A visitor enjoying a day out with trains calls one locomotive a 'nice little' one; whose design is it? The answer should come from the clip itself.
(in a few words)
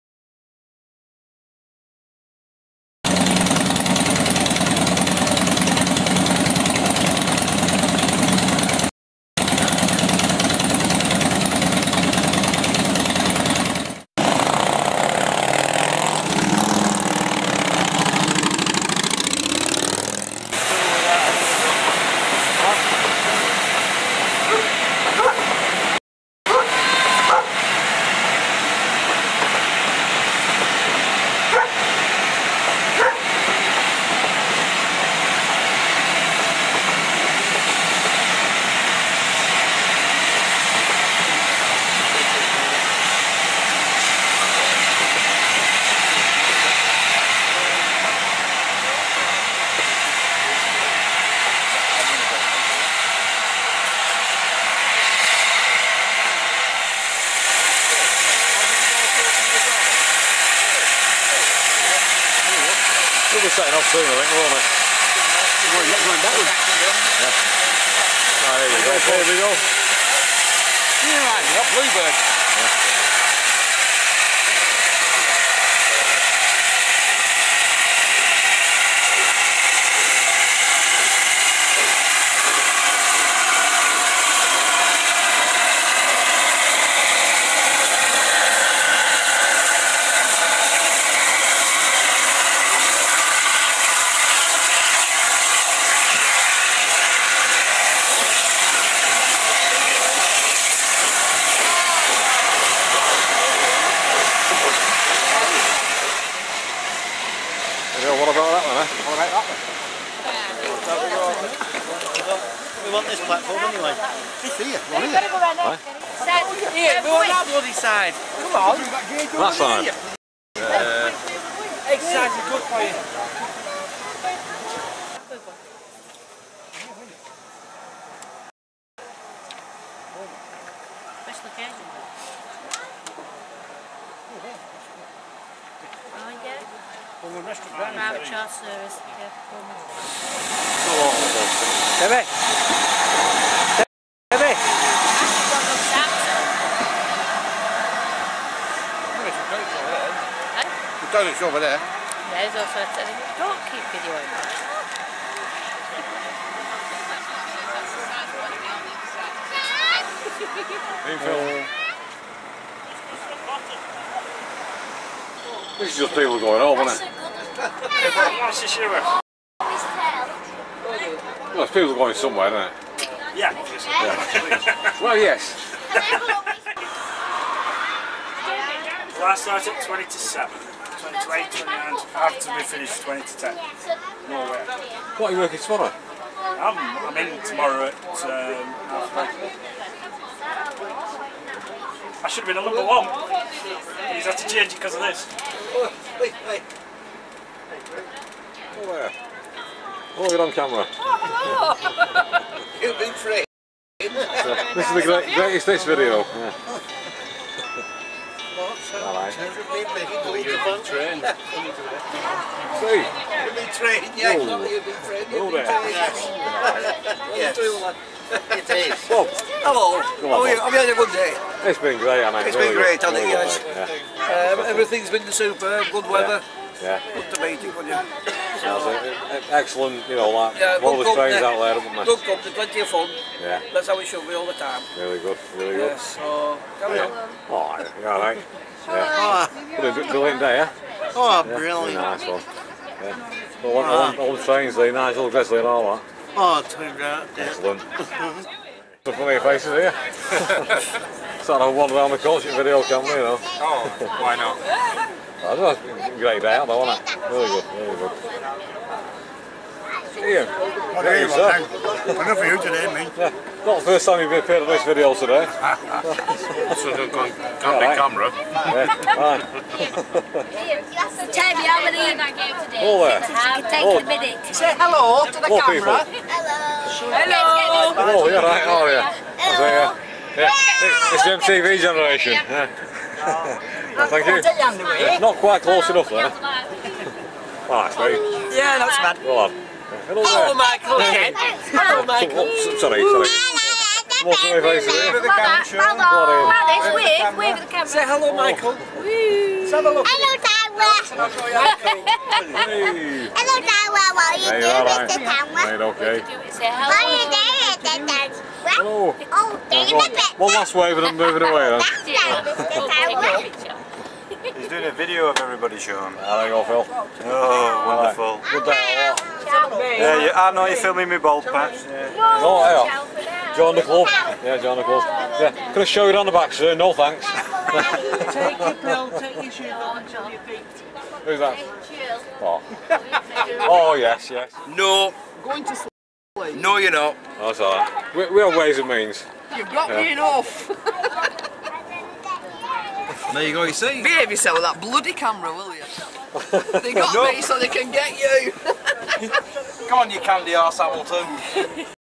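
Gresley.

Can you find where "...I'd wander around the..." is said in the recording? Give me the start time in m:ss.
4:11.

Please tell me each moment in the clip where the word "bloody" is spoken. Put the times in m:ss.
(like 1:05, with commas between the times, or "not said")
1:57, 5:44.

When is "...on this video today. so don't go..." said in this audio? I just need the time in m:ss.
4:24.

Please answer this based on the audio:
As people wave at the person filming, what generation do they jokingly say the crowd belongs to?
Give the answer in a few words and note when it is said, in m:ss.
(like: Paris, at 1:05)
MTV generation, at 4:41.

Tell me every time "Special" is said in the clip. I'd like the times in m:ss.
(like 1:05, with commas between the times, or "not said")
2:11.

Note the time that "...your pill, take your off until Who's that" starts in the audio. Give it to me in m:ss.
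5:28.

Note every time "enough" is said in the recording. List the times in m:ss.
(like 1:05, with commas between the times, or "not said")
4:21, 4:45, 5:40.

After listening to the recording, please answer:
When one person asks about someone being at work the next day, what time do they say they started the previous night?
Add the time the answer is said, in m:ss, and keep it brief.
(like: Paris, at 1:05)
20 to 7, at 2:59.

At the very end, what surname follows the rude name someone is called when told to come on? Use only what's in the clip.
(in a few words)
Hamilton.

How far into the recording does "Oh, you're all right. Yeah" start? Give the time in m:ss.
3:57.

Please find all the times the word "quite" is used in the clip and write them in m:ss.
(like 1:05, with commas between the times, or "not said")
4:45.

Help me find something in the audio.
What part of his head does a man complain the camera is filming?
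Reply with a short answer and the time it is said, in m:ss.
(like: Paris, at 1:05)
bald patch, at 5:21.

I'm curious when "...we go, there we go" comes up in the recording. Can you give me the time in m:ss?
1:08.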